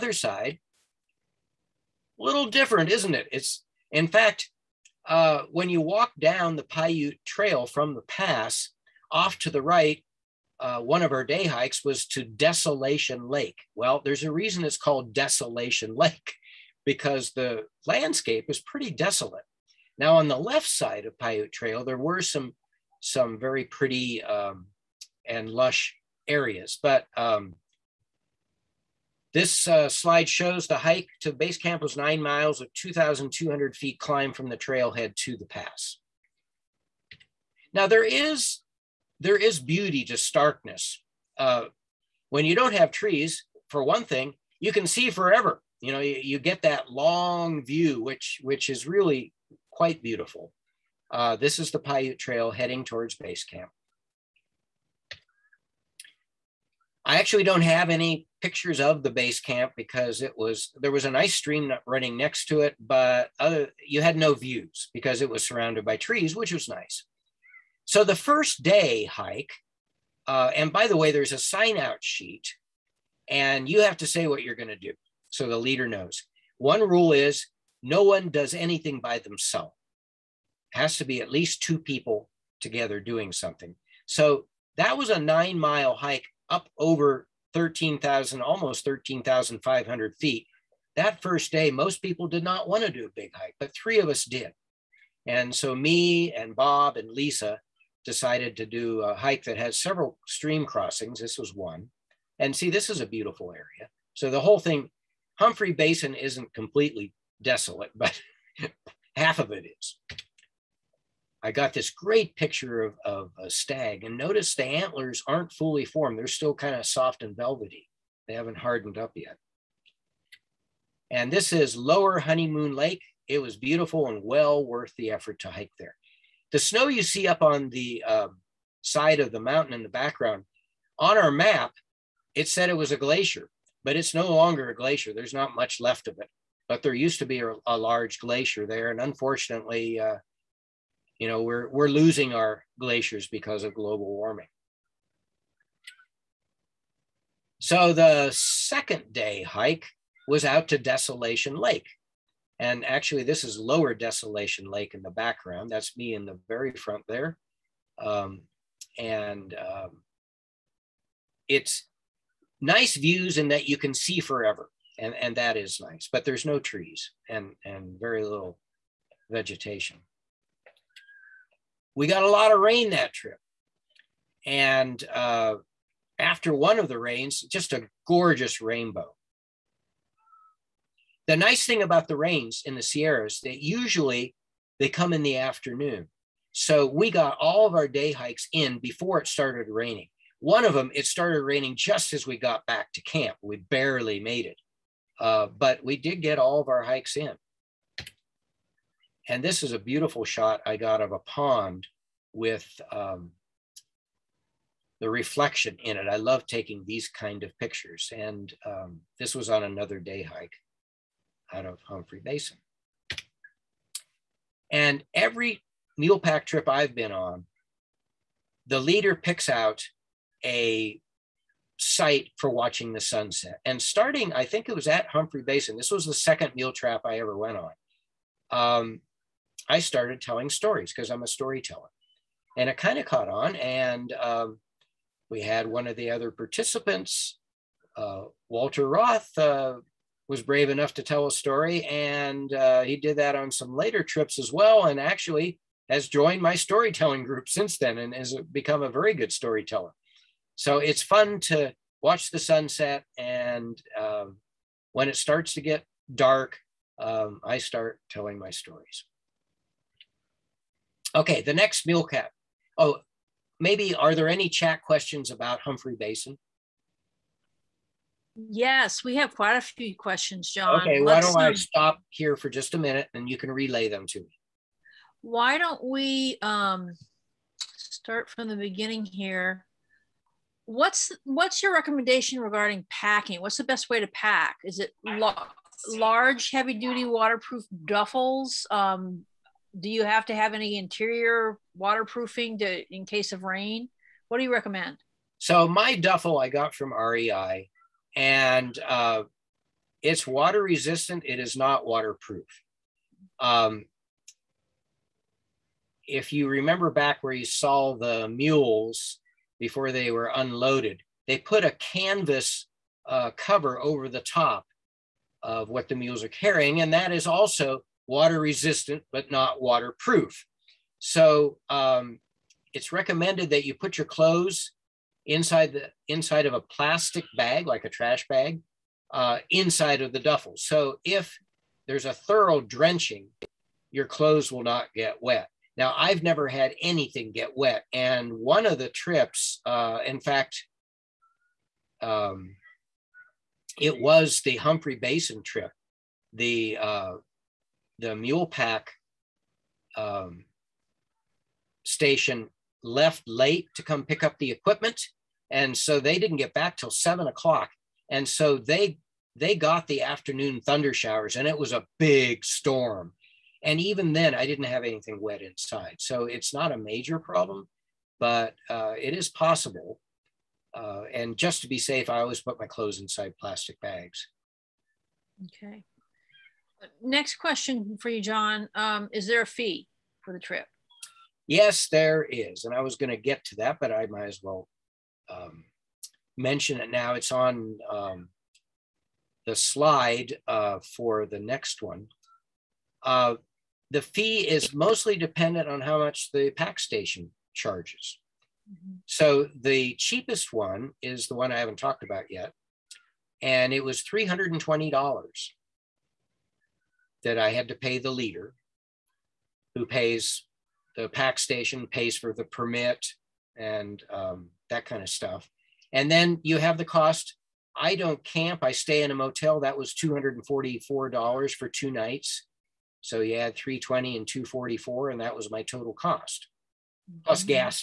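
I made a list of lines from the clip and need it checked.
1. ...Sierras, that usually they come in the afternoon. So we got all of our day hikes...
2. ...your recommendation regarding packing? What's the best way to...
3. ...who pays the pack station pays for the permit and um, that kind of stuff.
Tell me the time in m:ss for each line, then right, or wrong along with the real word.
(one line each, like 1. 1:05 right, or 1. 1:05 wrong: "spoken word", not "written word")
1. 3:02 right
2. 4:41 right
3. 6:49 right.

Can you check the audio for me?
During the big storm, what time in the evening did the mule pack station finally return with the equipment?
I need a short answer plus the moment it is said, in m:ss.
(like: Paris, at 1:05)
7 o'clock, at 5:56.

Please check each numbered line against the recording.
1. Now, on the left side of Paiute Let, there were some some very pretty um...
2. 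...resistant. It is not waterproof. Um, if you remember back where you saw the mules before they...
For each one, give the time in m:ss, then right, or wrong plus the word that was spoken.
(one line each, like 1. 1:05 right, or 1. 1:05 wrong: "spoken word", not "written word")
1. 0:19 wrong: "Trail", not "Let"
2. 5:00 right.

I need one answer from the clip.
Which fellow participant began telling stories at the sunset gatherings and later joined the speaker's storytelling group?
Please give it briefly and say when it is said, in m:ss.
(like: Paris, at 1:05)
Walter Roth, at 3:58.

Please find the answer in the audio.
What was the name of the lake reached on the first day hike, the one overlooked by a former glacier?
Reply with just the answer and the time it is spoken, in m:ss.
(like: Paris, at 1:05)
Lower Honeymoon Lake, at 2:01.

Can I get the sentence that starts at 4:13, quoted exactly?
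And um, when it starts to get dark, um, I start telling my stories.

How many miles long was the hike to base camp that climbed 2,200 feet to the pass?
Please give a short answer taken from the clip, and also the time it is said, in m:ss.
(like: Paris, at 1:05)
9, at 0:31.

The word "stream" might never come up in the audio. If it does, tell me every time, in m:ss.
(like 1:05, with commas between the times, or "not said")
1:01, 1:40.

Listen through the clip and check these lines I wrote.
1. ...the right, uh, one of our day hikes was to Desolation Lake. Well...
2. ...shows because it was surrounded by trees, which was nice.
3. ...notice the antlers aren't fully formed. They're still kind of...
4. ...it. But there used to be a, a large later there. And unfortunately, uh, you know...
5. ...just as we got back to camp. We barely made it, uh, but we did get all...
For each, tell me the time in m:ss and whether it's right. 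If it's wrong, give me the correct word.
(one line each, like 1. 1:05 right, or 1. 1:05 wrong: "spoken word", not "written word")
1. 0:09 right
2. 1:04 wrong: "views", not "shows"
3. 1:54 right
4. 2:16 wrong: "glacier", not "later"
5. 3:11 right.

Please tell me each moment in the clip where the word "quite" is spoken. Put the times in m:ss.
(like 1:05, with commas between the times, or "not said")
0:49, 4:29.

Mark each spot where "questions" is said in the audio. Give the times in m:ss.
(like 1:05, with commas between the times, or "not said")
4:24, 4:29, 6:17.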